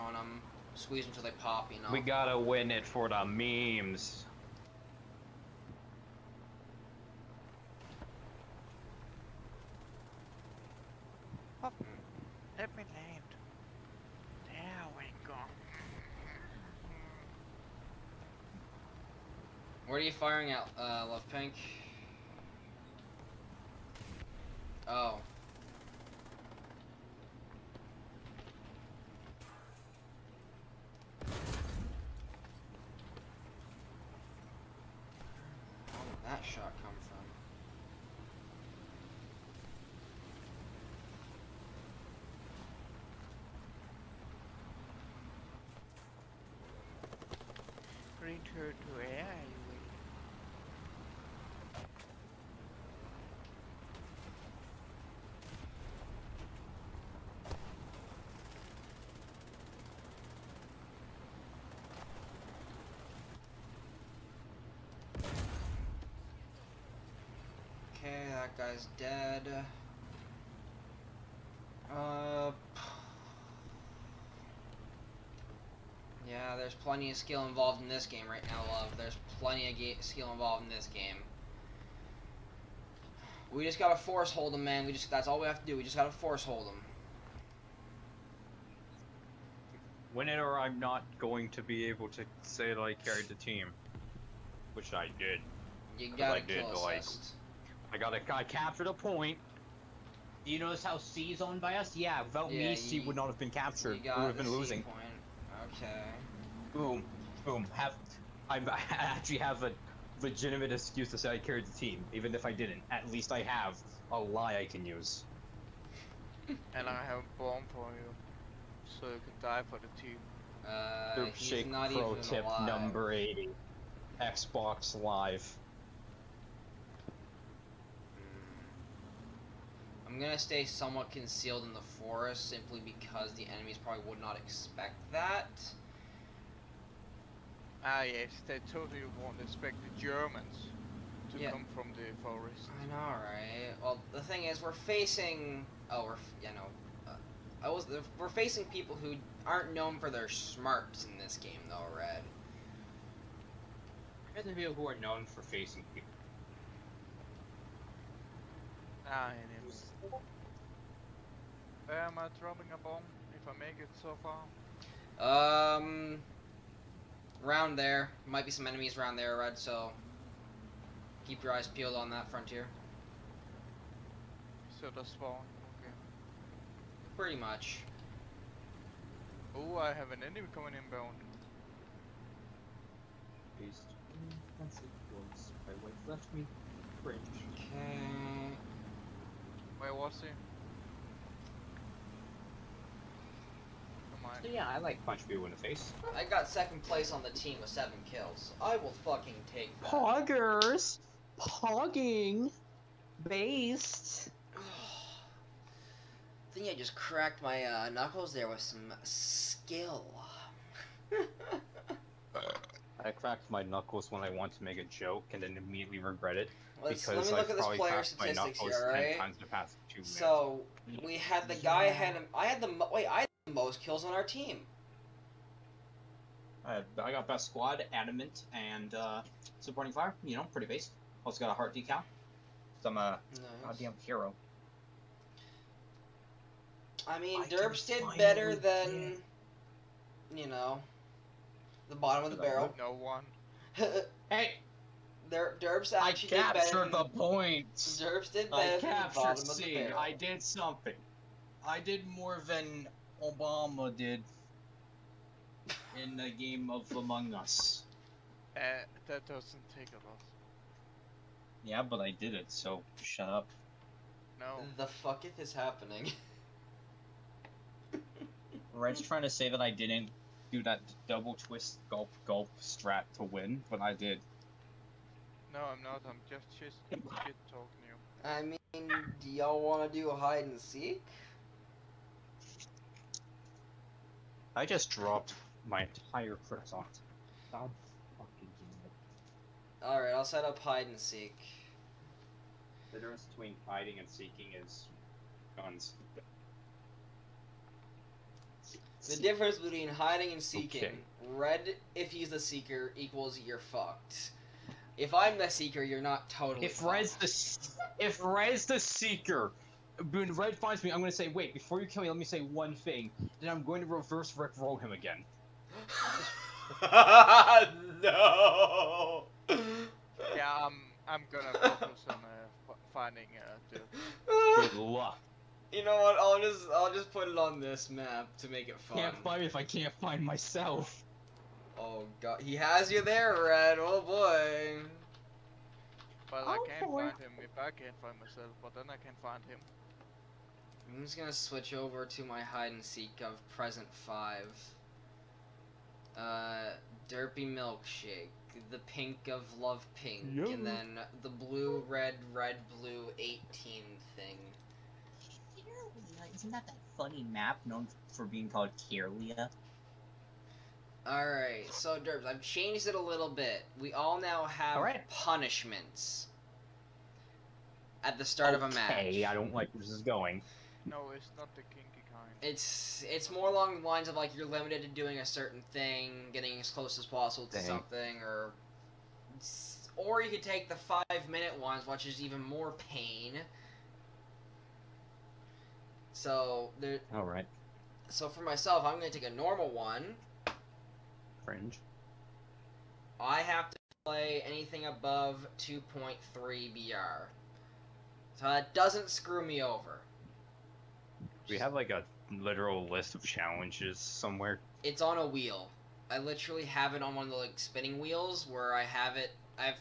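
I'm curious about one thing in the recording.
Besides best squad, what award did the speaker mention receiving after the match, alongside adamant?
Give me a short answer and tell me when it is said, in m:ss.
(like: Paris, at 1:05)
Supporting fire, at 3:49.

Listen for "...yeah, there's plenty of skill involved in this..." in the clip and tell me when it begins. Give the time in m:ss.
1:16.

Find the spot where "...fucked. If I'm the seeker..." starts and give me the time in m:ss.
5:03.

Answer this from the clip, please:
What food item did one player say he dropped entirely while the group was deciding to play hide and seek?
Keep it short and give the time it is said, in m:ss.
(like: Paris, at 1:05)
Croissant, at 4:46.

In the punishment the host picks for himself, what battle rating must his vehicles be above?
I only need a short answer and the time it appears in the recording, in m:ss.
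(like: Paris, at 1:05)
2.3, at 6:35.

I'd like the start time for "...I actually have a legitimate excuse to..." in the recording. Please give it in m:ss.
1:48.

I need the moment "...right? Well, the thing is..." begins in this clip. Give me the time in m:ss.
2:23.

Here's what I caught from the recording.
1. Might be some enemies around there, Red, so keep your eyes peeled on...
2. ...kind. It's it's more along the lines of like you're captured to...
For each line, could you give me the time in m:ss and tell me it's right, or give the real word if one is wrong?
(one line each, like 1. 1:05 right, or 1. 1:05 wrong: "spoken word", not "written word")
1. 2:48 right
2. 6:12 wrong: "limited", not "captured".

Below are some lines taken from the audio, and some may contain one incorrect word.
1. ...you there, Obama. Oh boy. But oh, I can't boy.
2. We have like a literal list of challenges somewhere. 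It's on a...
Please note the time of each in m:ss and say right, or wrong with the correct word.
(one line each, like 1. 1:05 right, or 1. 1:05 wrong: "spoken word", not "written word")
1. 5:32 wrong: "Red", not "Obama"
2. 6:41 right.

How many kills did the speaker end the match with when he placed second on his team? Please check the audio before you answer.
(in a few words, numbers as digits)
7.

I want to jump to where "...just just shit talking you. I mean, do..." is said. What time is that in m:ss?
4:36.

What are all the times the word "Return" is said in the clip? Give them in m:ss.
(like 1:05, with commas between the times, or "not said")
0:48.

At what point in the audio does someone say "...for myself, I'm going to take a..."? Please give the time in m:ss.
6:28.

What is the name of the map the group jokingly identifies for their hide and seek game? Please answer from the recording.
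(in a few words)
Karelia.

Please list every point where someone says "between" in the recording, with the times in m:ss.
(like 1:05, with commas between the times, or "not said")
4:53, 4:59.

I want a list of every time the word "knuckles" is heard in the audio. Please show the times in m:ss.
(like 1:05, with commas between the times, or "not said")
3:27, 3:33.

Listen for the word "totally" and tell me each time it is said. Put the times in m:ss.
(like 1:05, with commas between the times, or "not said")
2:18, 5:06.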